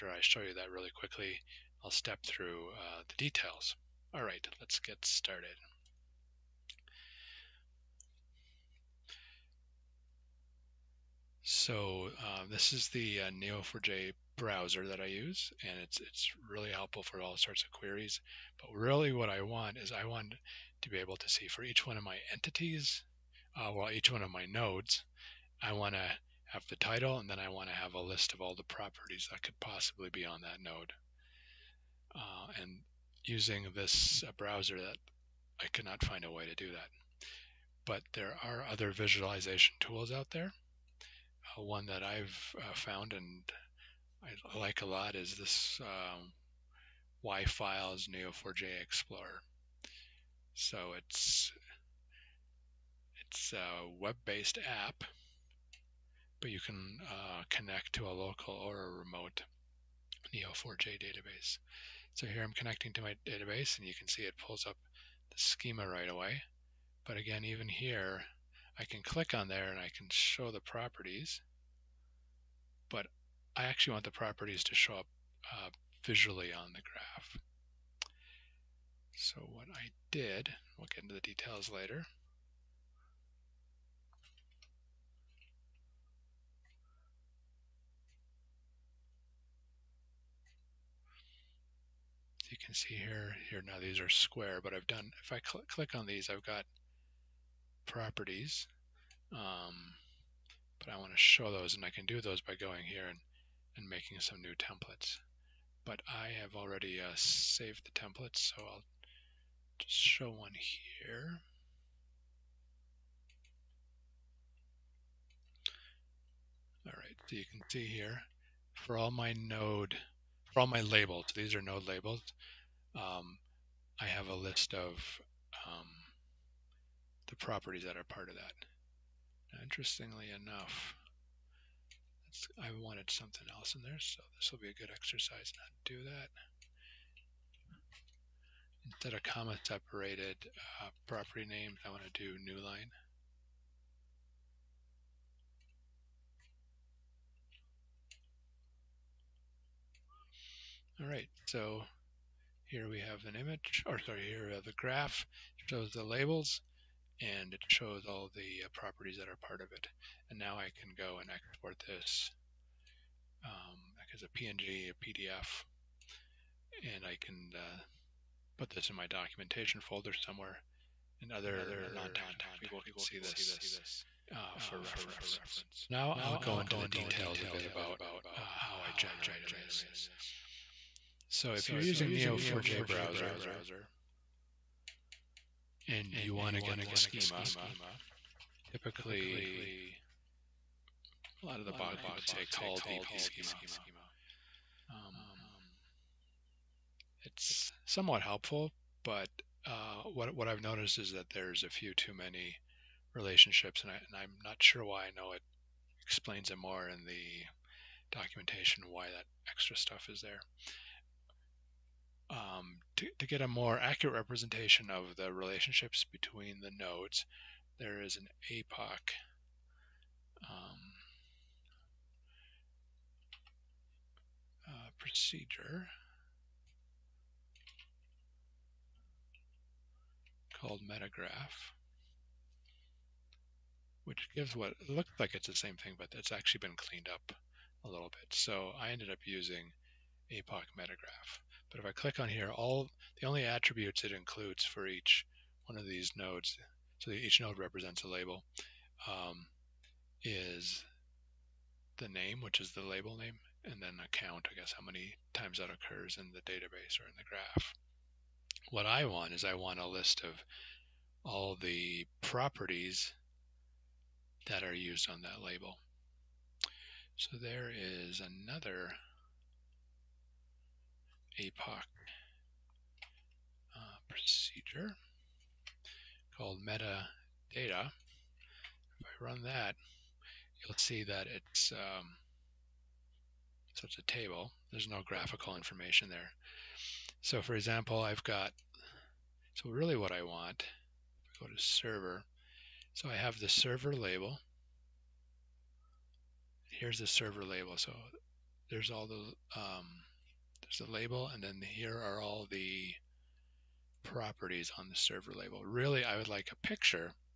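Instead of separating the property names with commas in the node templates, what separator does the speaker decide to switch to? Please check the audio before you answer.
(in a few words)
new line.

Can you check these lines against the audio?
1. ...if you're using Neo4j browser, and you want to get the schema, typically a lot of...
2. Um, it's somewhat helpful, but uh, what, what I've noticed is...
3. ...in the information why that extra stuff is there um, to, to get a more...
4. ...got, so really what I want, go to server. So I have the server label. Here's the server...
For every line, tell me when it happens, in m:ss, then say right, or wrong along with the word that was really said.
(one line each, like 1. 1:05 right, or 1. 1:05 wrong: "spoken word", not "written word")
1. 3:01 right
2. 3:14 right
3. 3:26 wrong: "documentation", not "information"
4. 4:48 right.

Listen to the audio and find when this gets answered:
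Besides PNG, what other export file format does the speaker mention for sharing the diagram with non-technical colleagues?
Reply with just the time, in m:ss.
2:45.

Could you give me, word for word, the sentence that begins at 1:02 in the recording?
So here I'm connecting to my database, and you can see it pulls up the schema right away.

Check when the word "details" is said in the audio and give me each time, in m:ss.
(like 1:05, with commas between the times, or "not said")
0:03, 1:21, 2:56.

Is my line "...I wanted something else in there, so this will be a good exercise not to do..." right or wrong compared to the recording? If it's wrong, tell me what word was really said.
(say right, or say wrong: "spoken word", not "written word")
right.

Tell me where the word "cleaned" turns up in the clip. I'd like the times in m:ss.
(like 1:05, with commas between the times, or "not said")
3:56.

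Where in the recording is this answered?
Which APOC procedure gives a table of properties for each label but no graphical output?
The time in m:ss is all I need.
4:36.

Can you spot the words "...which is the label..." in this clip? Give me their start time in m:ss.
4:12.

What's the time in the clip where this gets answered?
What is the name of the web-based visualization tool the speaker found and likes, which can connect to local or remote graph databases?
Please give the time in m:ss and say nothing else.
0:47.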